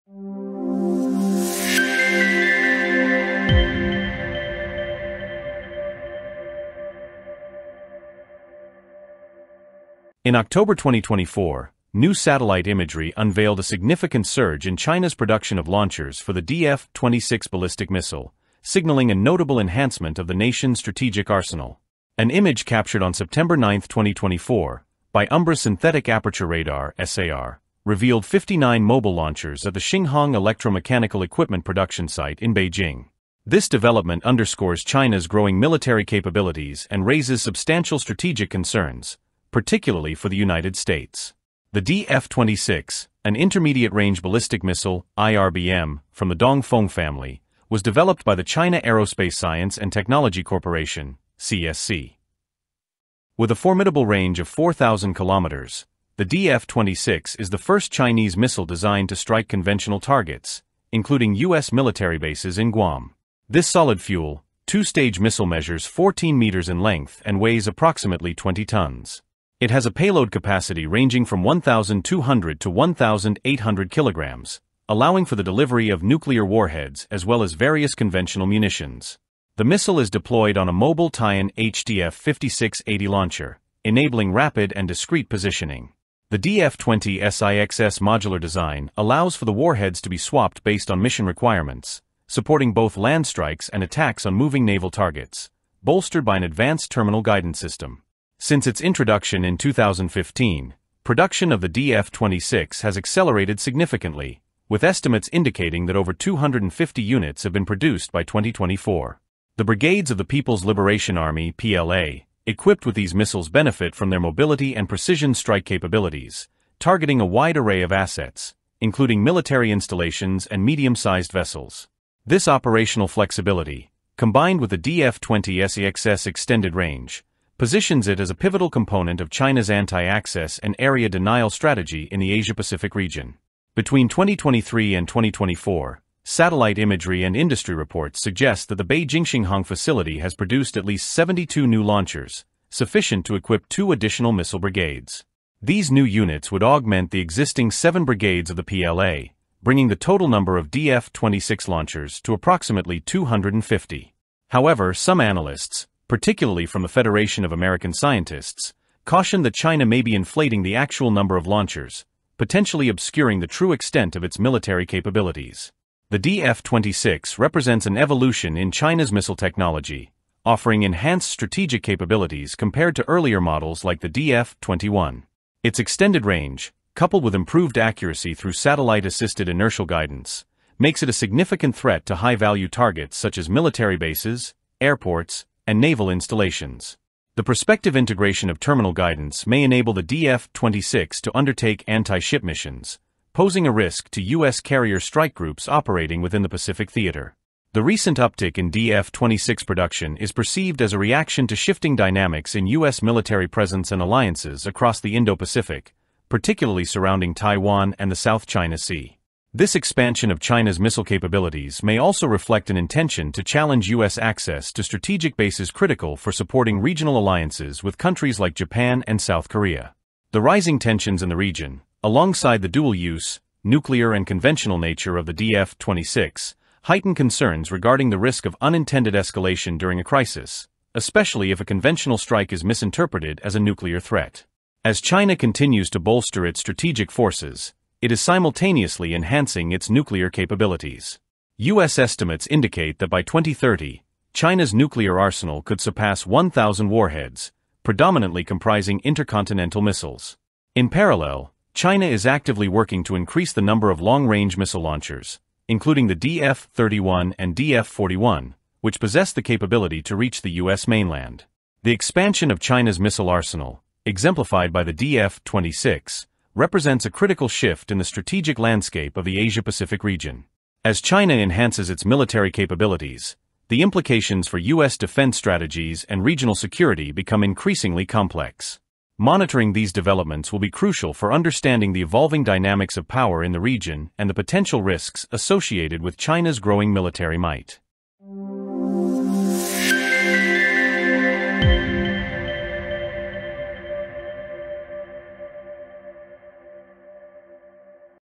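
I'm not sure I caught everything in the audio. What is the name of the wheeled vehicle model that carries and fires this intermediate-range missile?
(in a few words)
Taian HTF-5680.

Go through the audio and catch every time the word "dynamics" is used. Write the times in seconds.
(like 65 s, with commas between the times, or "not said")
201 s, 282 s.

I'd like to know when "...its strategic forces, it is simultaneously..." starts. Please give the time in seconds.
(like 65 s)
236 s.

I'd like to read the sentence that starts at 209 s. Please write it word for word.
This expansion of China's missile capabilities may also reflect an intention to challenge U.S.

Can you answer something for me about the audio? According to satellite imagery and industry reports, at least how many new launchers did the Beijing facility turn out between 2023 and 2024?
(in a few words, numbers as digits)
72.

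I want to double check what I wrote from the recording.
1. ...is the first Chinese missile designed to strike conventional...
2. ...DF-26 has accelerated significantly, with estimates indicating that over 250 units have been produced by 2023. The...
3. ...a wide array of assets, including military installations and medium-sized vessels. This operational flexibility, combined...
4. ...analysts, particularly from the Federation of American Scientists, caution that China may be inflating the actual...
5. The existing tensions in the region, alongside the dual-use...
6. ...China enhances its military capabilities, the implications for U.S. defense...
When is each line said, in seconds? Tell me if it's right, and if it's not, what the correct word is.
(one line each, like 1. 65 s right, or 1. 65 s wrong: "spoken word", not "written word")
1. 57 s right
2. 101 s wrong: "2024", not "2023"
3. 117 s right
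4. 155 s right
5. 220 s wrong: "rising", not "existing"
6. 271 s right.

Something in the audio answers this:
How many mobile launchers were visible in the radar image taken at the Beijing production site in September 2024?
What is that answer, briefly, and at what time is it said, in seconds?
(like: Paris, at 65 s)
59, at 28 s.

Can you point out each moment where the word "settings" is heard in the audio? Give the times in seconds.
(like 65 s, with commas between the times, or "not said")
not said.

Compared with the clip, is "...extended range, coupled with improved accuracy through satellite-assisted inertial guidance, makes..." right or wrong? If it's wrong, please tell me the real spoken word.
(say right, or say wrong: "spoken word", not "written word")
right.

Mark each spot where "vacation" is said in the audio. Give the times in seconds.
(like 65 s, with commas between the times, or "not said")
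not said.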